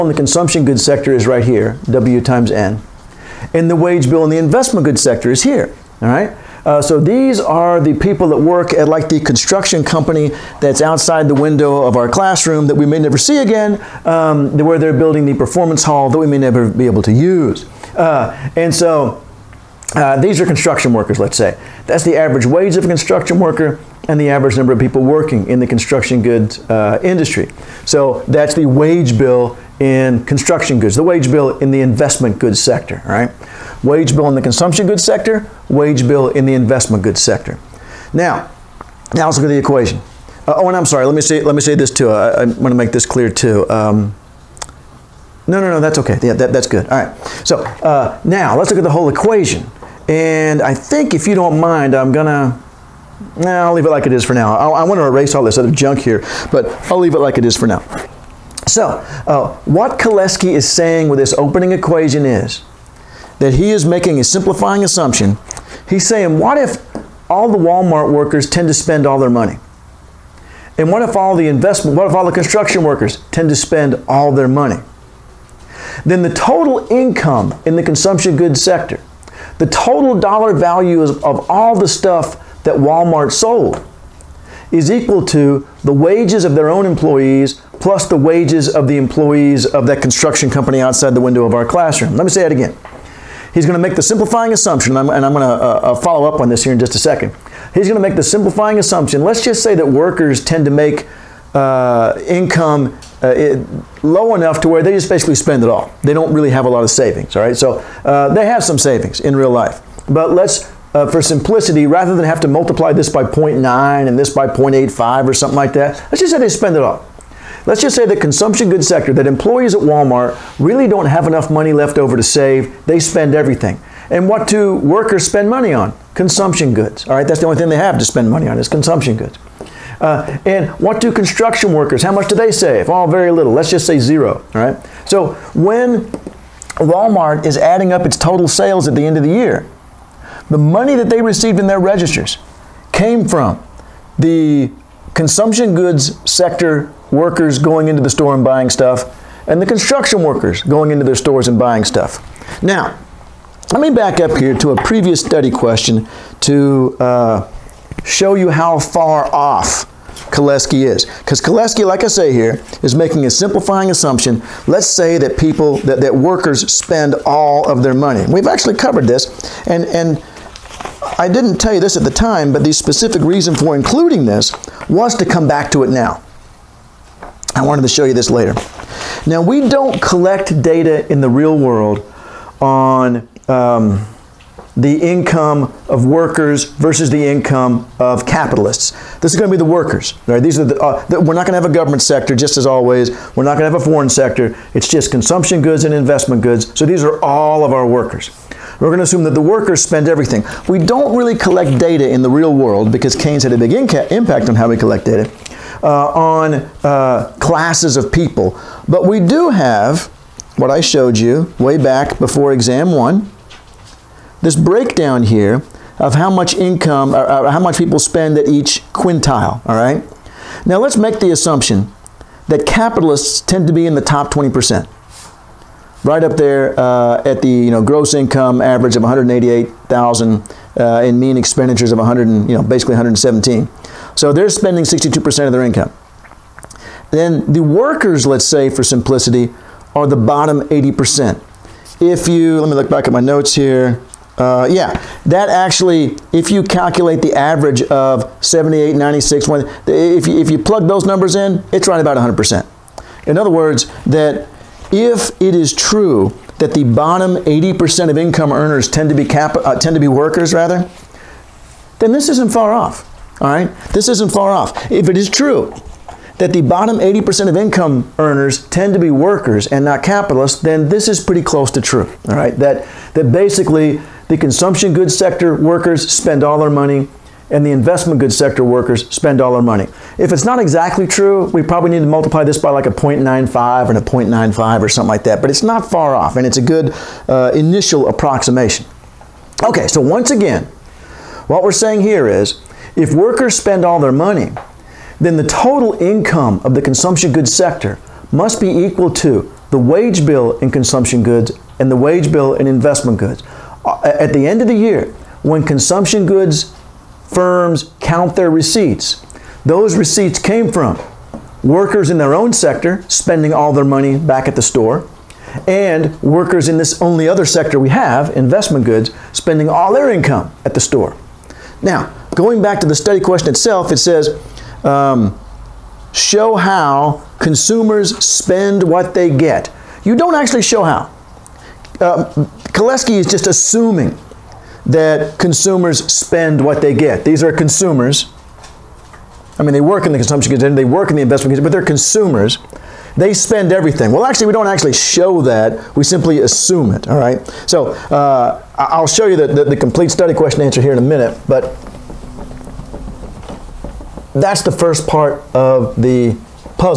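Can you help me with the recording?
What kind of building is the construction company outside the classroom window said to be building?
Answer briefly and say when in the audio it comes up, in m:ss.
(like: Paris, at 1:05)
performance hall, at 0:15.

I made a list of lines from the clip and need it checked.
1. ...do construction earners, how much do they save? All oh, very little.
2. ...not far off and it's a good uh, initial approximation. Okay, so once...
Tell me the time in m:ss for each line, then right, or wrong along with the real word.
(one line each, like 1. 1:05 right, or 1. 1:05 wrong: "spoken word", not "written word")
1. 2:10 wrong: "workers", not "earners"
2. 4:45 right.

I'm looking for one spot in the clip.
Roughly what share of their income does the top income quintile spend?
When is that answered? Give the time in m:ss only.
3:54.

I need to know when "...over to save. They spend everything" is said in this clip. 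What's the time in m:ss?
2:01.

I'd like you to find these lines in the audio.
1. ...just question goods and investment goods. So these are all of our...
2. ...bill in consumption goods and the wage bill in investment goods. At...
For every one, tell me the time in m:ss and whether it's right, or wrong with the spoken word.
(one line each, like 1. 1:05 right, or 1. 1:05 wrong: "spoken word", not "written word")
1. 3:14 wrong: "consumption", not "question"
2. 5:00 right.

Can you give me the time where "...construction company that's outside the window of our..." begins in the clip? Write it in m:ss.
0:09.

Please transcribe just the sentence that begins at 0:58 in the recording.
So, uh, what Kalecki is saying with this opening equation is that he is making a simplifying assumption.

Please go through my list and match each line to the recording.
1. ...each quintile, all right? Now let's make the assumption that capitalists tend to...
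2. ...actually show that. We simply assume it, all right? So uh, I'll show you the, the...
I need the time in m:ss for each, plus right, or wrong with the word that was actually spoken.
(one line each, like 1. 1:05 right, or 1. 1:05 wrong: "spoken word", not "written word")
1. 3:38 right
2. 5:44 right.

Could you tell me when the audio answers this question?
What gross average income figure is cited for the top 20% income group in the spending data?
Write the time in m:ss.
3:49.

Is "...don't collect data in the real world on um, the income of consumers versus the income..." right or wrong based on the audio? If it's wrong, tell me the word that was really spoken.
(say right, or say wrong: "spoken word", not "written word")
wrong: "workers", not "consumers".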